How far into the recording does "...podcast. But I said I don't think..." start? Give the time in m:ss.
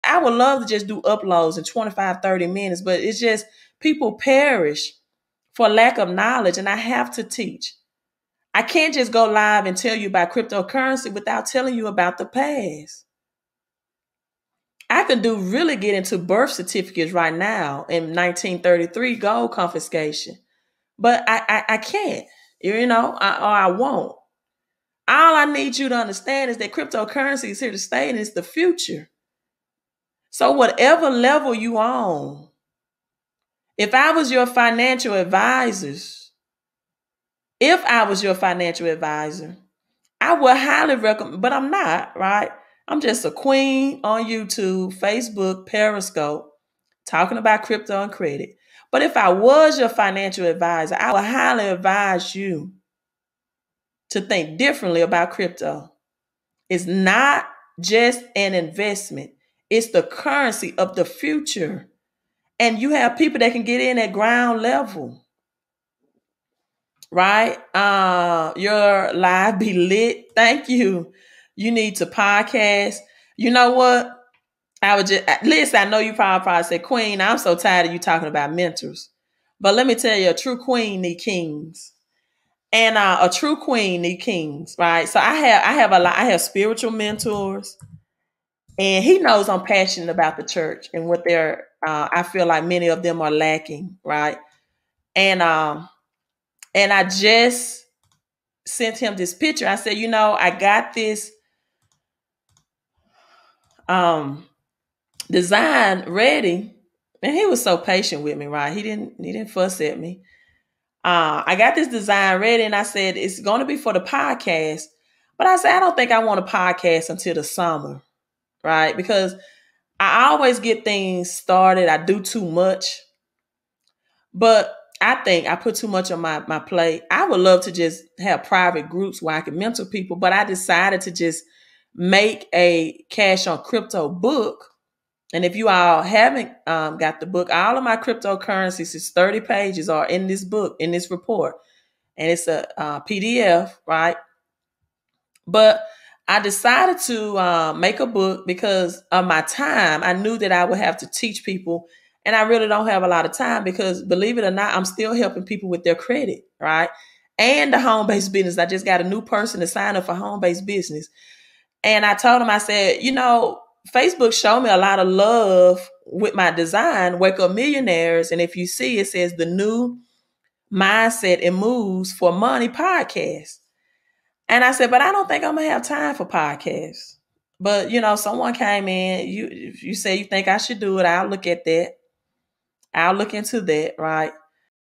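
1:54.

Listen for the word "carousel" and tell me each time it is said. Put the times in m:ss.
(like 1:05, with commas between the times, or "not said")
not said.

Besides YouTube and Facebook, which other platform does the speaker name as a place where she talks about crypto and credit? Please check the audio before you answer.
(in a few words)
Periscope.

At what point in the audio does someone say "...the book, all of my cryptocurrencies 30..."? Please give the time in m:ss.
2:17.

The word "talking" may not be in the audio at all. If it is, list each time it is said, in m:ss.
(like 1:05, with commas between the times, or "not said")
0:47, 1:17.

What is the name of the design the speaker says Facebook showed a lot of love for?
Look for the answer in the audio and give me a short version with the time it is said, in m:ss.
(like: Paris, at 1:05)
Wake Up Millionaires, at 2:47.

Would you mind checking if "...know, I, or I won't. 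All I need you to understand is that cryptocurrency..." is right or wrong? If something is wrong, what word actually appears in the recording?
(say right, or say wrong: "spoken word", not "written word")
right.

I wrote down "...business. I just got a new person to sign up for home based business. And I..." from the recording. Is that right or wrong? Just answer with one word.
right.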